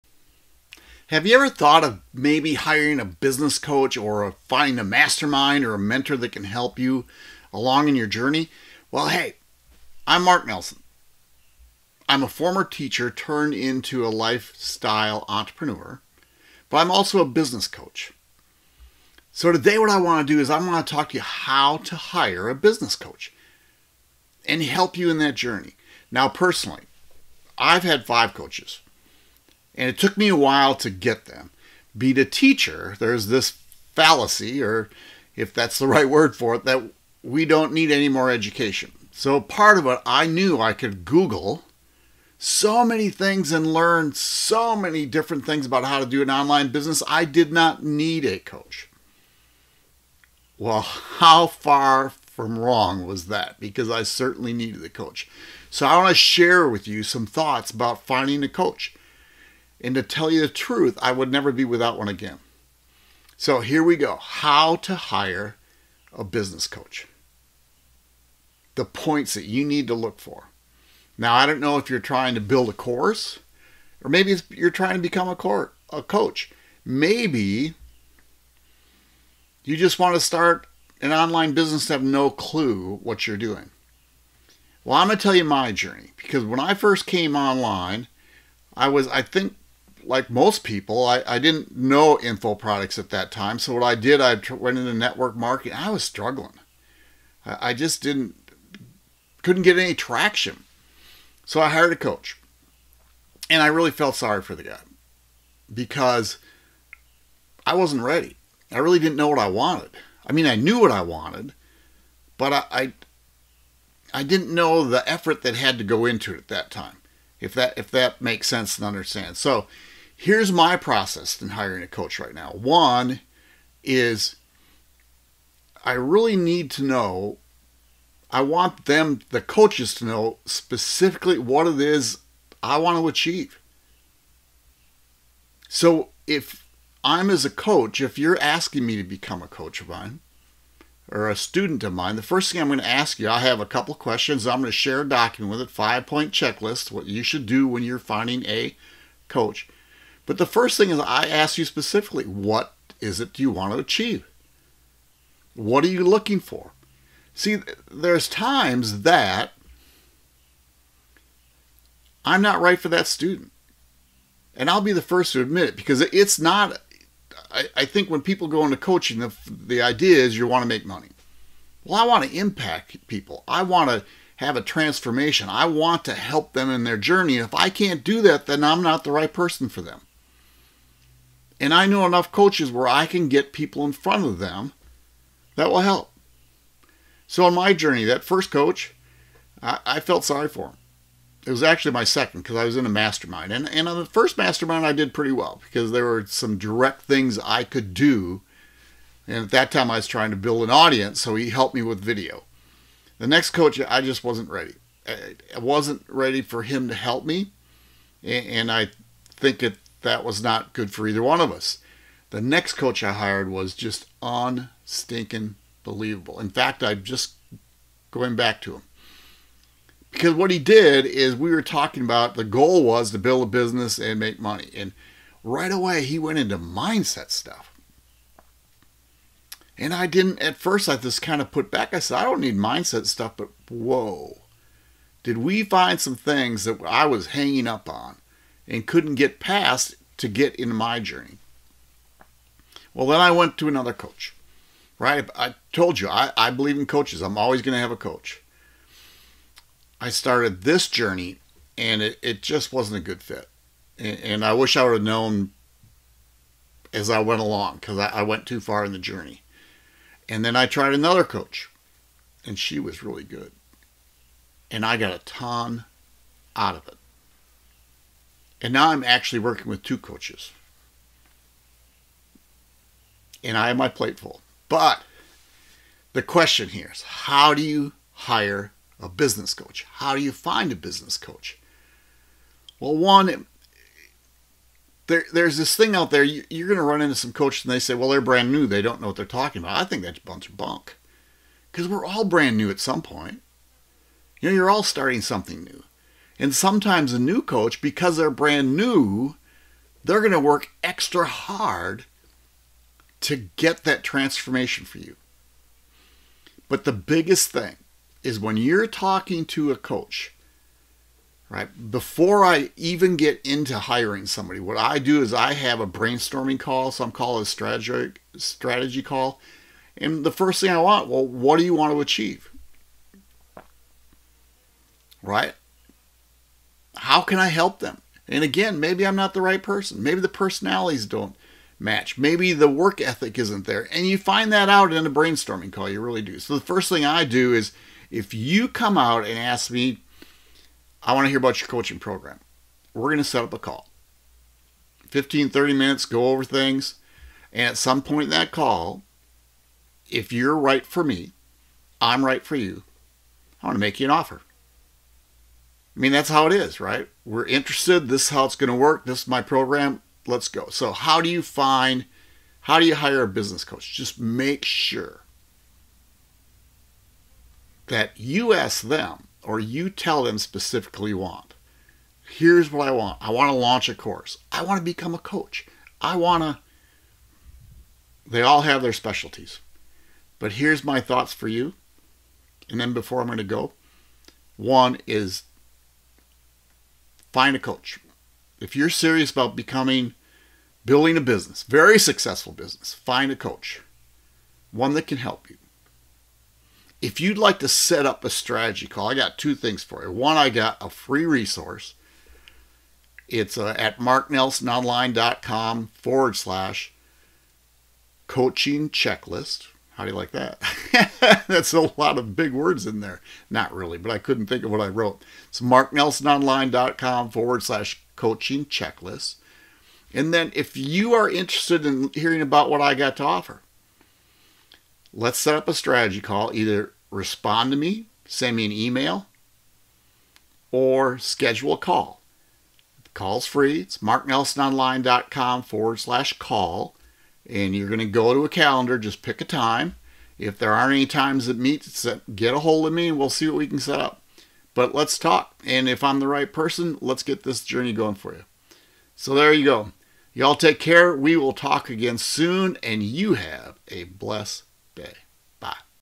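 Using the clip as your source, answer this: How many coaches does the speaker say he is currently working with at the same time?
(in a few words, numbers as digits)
2.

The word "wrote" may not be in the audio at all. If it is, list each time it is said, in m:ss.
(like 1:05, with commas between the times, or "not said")
6:54.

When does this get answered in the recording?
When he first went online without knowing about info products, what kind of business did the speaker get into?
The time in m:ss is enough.
1:34.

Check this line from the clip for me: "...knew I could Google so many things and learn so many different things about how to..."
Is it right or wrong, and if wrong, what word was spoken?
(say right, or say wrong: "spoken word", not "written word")
right.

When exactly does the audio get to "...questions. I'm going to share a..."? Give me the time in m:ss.
2:23.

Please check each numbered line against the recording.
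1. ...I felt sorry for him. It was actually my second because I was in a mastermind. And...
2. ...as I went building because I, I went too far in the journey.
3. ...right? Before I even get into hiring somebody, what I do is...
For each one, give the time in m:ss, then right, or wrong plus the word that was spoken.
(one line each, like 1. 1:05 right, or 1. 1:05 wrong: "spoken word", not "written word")
1. 3:09 right
2. 4:16 wrong: "along", not "building"
3. 5:11 right.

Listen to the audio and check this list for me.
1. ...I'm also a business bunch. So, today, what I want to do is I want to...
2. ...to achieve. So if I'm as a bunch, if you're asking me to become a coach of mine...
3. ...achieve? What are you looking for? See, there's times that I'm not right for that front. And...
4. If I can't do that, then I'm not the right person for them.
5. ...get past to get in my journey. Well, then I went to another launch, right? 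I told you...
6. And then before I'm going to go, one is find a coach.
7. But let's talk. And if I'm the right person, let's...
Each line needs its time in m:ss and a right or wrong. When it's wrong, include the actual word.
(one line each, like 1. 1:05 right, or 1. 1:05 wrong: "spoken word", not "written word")
1. 0:16 wrong: "coach", not "bunch"
2. 2:12 wrong: "coach", not "bunch"
3. 2:33 wrong: "student", not "front"
4. 2:57 right
5. 3:59 wrong: "coach", not "launch"
6. 6:22 right
7. 7:24 right.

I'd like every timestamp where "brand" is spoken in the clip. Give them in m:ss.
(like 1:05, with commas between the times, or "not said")
4:48, 4:52, 4:58.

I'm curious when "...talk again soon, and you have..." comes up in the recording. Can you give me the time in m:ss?
7:31.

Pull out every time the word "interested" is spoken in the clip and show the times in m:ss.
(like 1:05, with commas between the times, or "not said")
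5:57, 7:01.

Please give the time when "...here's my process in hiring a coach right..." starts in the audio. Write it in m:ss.
2:00.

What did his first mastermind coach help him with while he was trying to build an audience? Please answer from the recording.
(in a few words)
video.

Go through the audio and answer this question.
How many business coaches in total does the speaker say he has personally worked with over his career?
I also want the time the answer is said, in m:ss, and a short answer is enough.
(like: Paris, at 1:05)
5, at 0:28.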